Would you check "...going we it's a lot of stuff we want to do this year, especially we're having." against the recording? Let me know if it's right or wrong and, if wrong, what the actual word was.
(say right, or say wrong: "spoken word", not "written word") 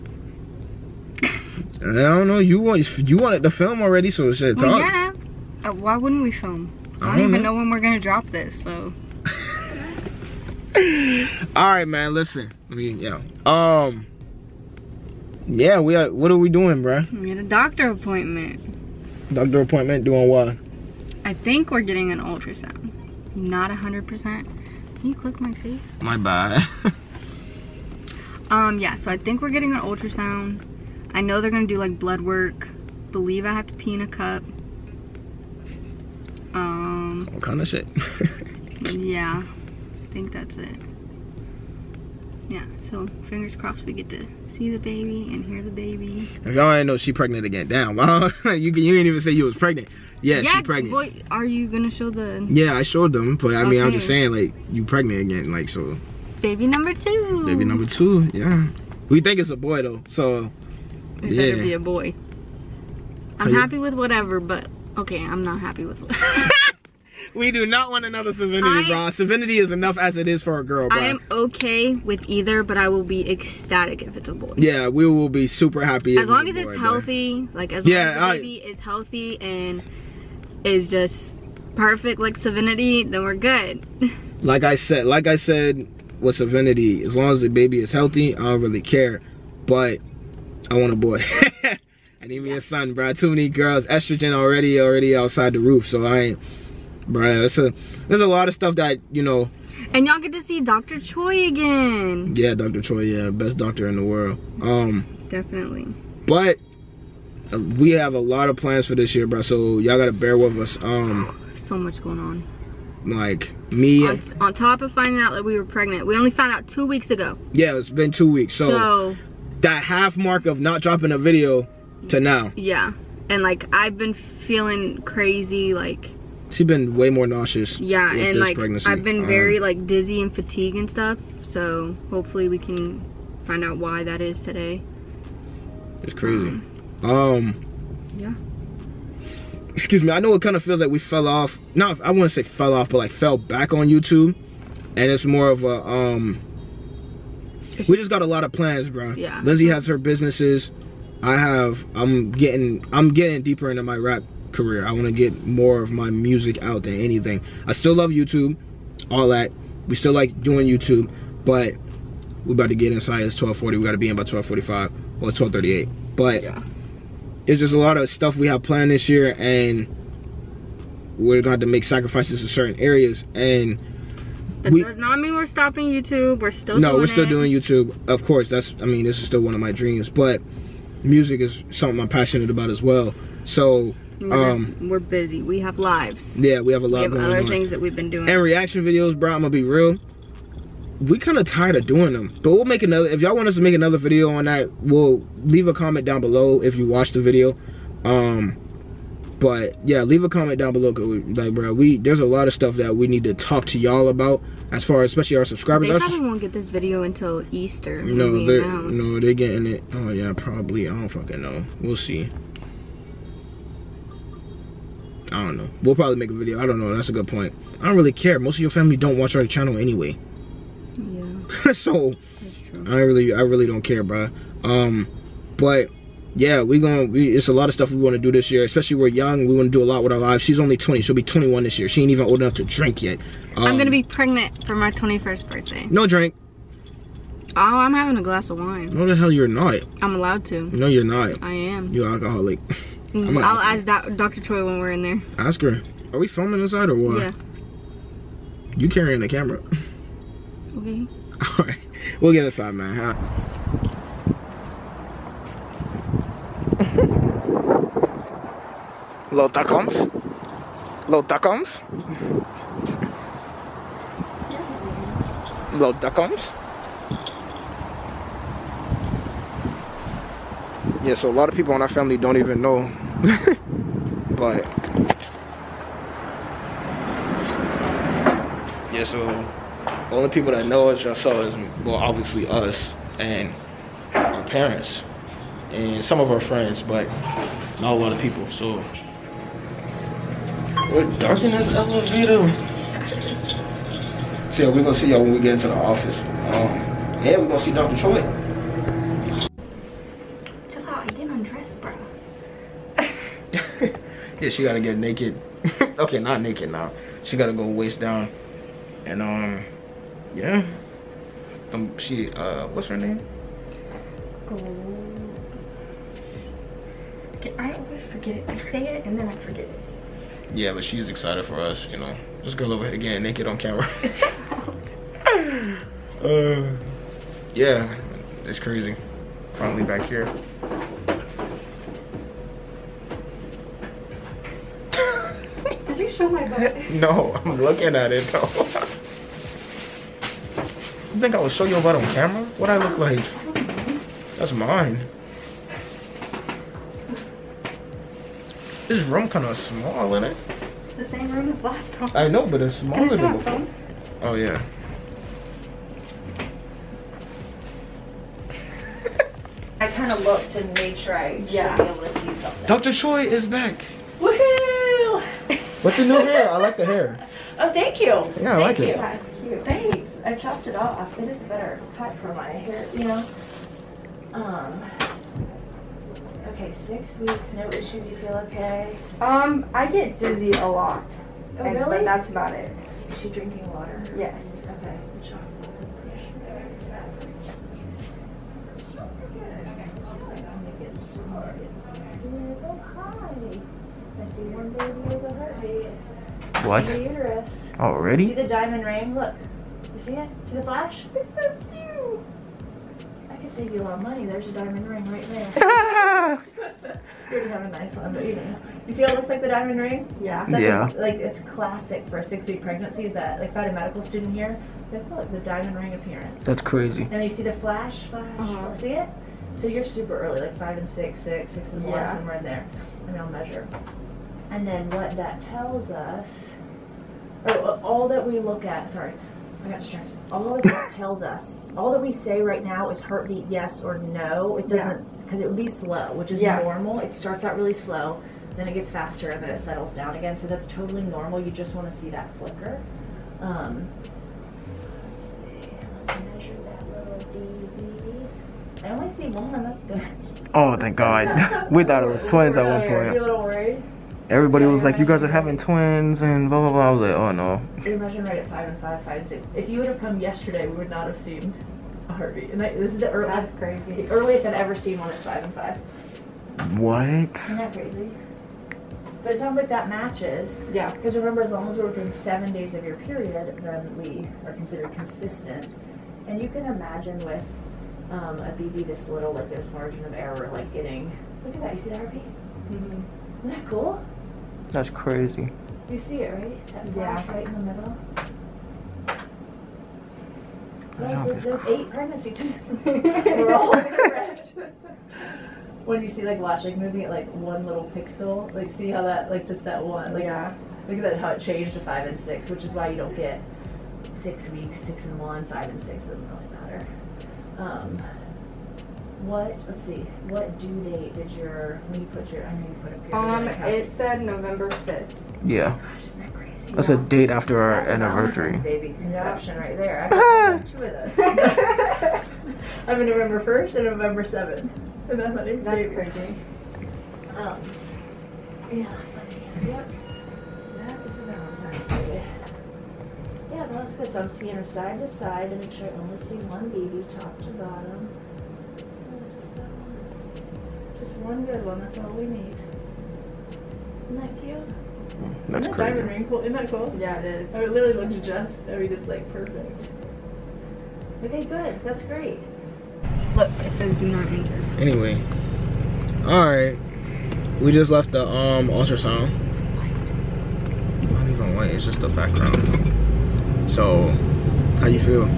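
wrong: "young", not "having".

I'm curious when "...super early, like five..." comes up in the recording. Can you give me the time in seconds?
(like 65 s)
419 s.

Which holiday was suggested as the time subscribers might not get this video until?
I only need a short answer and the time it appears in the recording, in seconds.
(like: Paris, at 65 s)
Easter, at 207 s.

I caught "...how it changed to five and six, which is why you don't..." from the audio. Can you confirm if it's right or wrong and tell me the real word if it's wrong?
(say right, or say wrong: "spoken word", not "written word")
right.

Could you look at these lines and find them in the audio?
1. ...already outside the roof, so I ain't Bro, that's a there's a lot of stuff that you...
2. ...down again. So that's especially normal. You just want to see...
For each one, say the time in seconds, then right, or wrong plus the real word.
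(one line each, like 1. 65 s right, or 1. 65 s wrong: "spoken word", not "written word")
1. 94 s right
2. 439 s wrong: "totally", not "especially".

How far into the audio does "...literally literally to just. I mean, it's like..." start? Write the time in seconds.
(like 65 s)
547 s.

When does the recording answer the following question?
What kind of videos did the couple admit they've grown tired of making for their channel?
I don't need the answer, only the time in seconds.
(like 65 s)
188 s.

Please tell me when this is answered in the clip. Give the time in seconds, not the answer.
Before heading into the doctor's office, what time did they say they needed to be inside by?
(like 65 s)
164 s.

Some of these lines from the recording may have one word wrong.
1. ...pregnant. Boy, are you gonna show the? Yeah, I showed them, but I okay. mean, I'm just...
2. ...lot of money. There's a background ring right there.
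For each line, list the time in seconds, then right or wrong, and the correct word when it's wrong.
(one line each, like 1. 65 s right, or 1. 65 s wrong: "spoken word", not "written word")
1. 50 s right
2. 403 s wrong: "diamond", not "background".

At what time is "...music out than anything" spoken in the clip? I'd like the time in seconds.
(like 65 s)
156 s.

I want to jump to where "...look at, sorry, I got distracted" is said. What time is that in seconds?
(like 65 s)
428 s.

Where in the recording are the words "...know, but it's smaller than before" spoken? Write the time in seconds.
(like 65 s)
352 s.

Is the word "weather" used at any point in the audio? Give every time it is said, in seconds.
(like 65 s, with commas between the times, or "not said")
not said.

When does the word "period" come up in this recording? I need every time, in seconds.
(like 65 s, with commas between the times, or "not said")
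472 s, 512 s.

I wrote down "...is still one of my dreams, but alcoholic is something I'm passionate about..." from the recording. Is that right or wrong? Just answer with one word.
wrong.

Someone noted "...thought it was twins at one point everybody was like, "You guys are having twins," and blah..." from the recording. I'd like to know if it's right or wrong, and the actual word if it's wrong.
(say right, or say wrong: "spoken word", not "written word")
right.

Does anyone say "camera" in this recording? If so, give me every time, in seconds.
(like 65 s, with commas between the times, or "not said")
249 s, 323 s, 342 s.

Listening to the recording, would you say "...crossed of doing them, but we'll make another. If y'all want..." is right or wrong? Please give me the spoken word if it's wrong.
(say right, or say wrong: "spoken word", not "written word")
wrong: "tired", not "crossed".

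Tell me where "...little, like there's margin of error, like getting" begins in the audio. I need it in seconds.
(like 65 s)
479 s.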